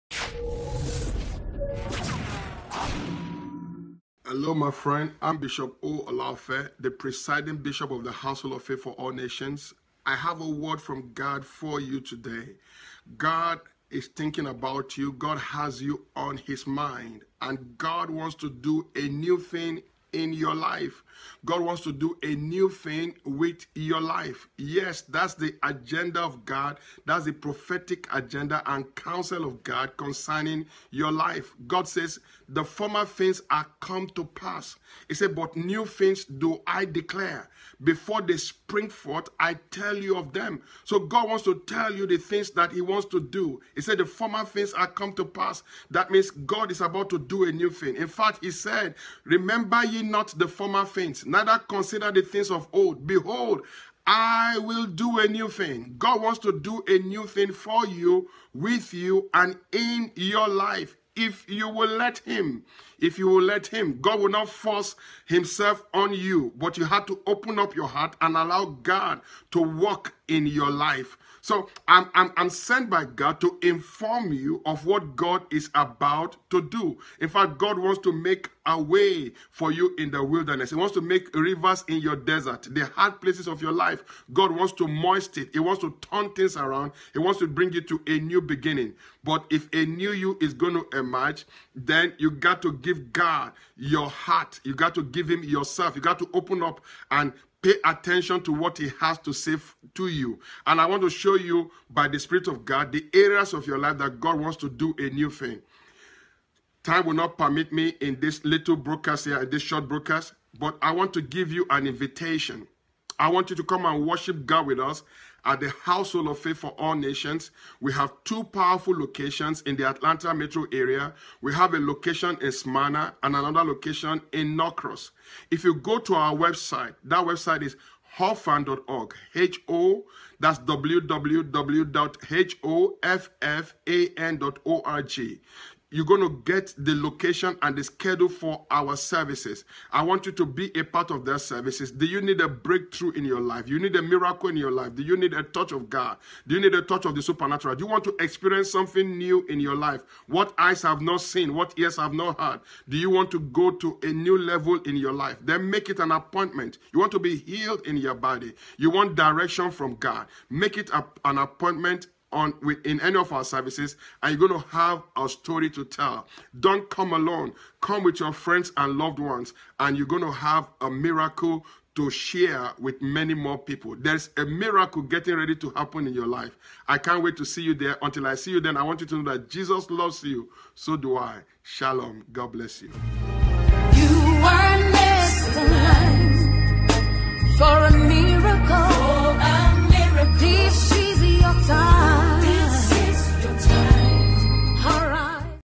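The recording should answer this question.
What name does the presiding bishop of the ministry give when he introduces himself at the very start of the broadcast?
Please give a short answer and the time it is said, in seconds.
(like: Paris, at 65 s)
Bishop O. Olaofe, at 5 s.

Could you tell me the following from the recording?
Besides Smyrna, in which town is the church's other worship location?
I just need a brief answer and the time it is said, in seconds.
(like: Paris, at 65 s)
Norcross, at 124 s.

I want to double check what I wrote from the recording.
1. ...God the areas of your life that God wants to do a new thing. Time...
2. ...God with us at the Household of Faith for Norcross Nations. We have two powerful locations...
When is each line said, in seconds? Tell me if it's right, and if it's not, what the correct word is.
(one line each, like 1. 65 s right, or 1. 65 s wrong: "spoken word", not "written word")
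1. 102 s right
2. 114 s wrong: "All", not "Norcross".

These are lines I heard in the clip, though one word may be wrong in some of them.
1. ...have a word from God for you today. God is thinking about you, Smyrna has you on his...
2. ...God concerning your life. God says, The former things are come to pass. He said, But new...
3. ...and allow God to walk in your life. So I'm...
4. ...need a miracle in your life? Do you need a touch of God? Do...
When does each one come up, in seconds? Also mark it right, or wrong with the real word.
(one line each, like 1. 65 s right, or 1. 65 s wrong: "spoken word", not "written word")
1. 10 s wrong: "God", not "Smyrna"
2. 29 s right
3. 68 s right
4. 143 s right.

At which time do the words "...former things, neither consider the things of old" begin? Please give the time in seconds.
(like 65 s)
50 s.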